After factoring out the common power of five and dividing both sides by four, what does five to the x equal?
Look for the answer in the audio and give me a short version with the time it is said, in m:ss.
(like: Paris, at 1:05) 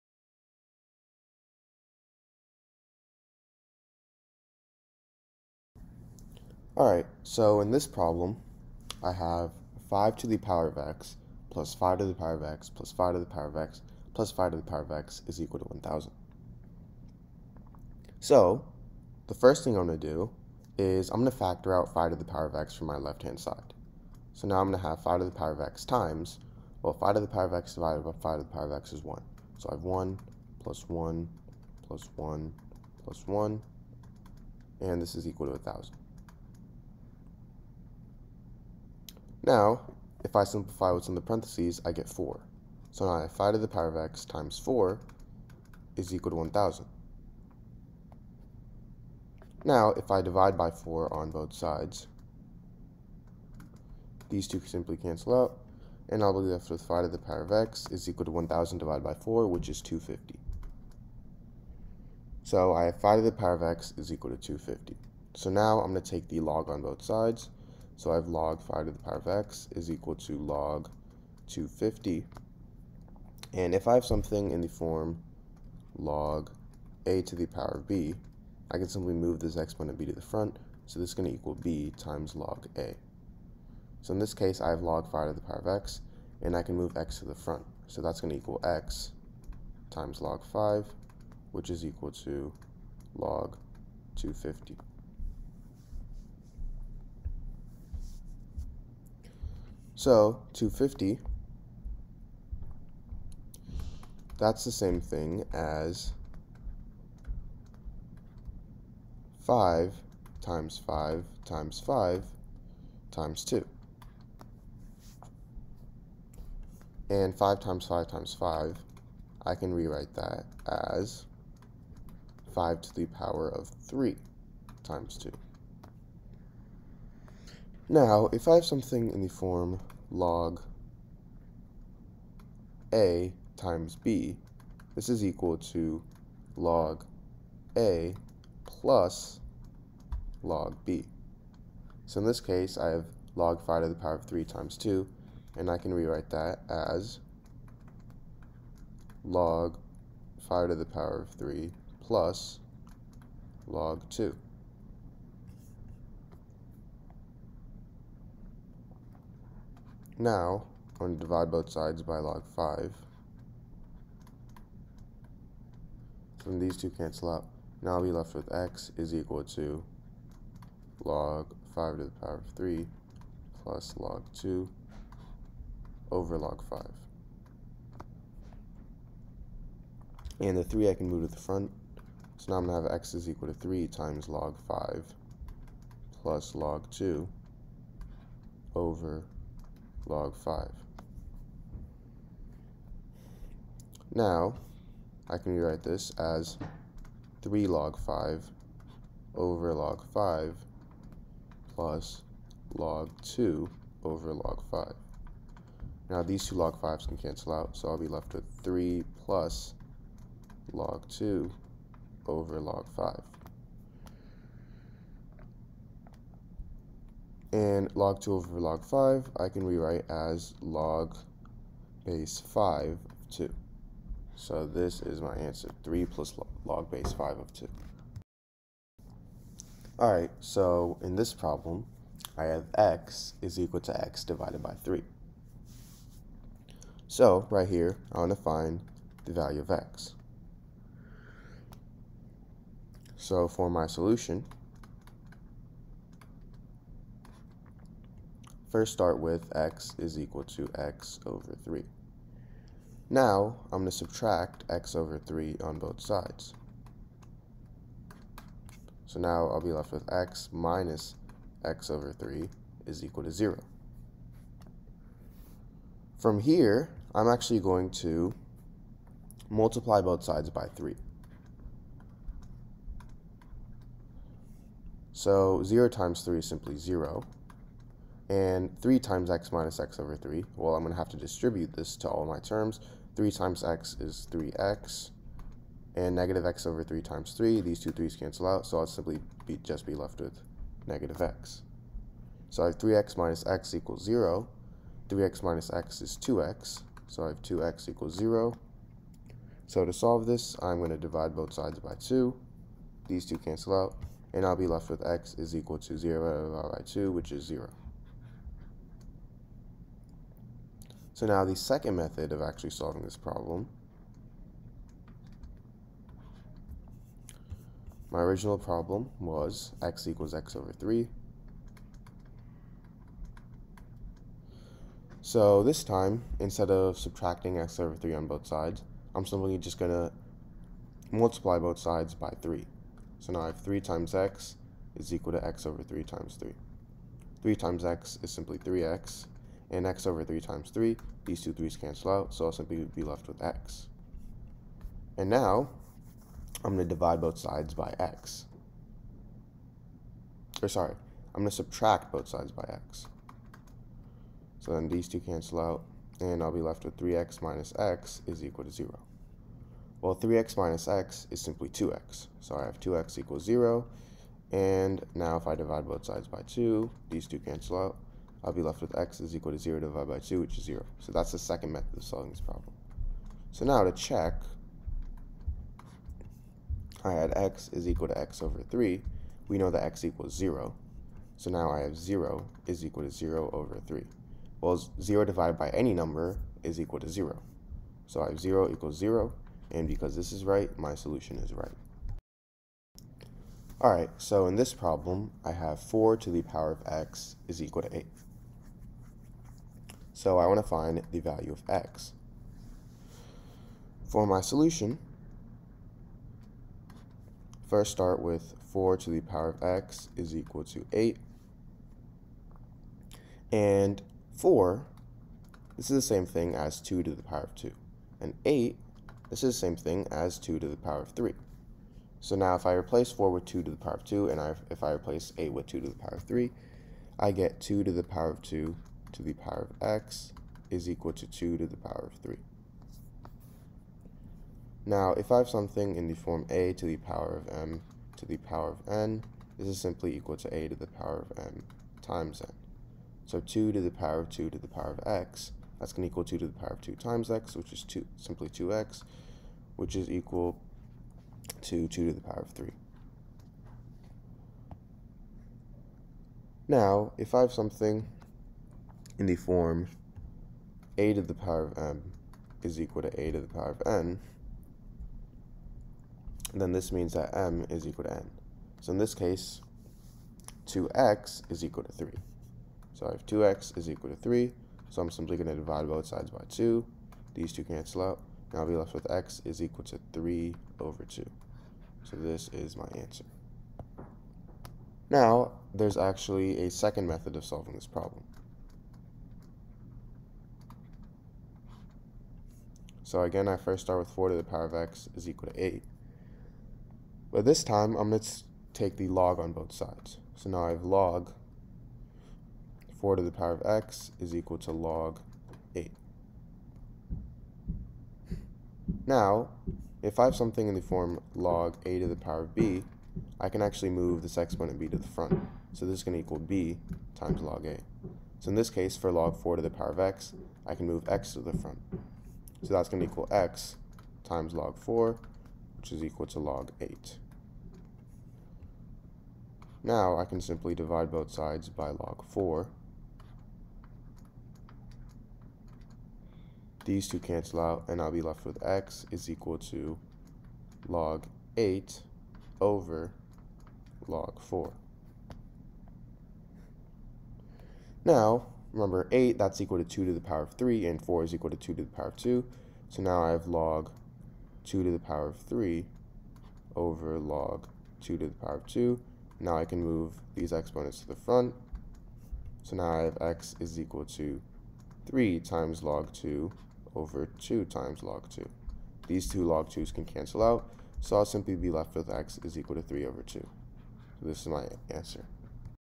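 250, at 0:59.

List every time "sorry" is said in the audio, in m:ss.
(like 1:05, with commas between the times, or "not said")
5:50.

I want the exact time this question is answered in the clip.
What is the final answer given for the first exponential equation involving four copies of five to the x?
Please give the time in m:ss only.
3:45.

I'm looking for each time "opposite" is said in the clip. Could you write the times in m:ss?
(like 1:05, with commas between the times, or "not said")
not said.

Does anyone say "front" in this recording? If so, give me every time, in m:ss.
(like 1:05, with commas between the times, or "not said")
1:20, 1:27, 3:01, 8:35, 8:41, 9:21.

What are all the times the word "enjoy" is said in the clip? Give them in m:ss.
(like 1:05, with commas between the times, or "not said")
not said.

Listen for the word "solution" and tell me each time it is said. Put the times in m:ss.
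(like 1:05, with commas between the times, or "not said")
4:03, 6:30, 6:44.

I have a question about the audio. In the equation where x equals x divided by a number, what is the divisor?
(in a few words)
3.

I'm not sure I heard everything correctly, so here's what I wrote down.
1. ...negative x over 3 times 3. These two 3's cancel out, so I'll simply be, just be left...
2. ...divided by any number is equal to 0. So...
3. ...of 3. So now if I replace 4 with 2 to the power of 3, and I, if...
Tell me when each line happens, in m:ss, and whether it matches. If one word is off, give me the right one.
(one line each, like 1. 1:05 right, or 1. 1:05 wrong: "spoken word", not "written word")
1. 4:46 right
2. 6:25 right
3. 7:01 wrong: "2", not "3".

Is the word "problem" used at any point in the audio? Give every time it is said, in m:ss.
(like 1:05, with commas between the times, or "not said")
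0:07, 3:51, 5:13, 5:18, 6:12, 6:34, 8:07.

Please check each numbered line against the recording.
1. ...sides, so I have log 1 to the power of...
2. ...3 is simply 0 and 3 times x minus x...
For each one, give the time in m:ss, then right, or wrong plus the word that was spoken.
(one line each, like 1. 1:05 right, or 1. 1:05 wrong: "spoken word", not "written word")
1. 1:07 wrong: "5", not "1"
2. 4:36 right.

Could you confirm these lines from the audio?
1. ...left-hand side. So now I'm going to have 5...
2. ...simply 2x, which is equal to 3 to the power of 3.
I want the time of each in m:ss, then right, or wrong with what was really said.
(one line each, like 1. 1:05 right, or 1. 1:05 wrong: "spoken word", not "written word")
1. 0:22 right
2. 7:28 wrong: "2", not "3".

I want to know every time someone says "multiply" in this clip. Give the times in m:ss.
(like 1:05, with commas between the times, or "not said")
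4:29, 5:31.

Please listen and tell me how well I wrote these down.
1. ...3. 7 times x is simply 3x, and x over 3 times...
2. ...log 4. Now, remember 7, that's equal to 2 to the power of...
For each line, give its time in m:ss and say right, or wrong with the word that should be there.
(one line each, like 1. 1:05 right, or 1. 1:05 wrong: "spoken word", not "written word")
1. 5:36 wrong: "3", not "7"
2. 9:04 wrong: "8", not "7".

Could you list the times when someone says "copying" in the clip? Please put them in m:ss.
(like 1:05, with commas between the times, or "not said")
not said.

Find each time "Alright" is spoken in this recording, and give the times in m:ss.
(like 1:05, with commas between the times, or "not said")
0:06, 3:49, 6:33.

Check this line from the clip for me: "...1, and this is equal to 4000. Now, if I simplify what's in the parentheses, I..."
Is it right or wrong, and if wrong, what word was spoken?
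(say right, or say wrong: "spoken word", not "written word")
wrong: "1000", not "4000".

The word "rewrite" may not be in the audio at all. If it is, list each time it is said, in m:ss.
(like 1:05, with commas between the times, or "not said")
1:59, 2:25, 3:15, 3:39.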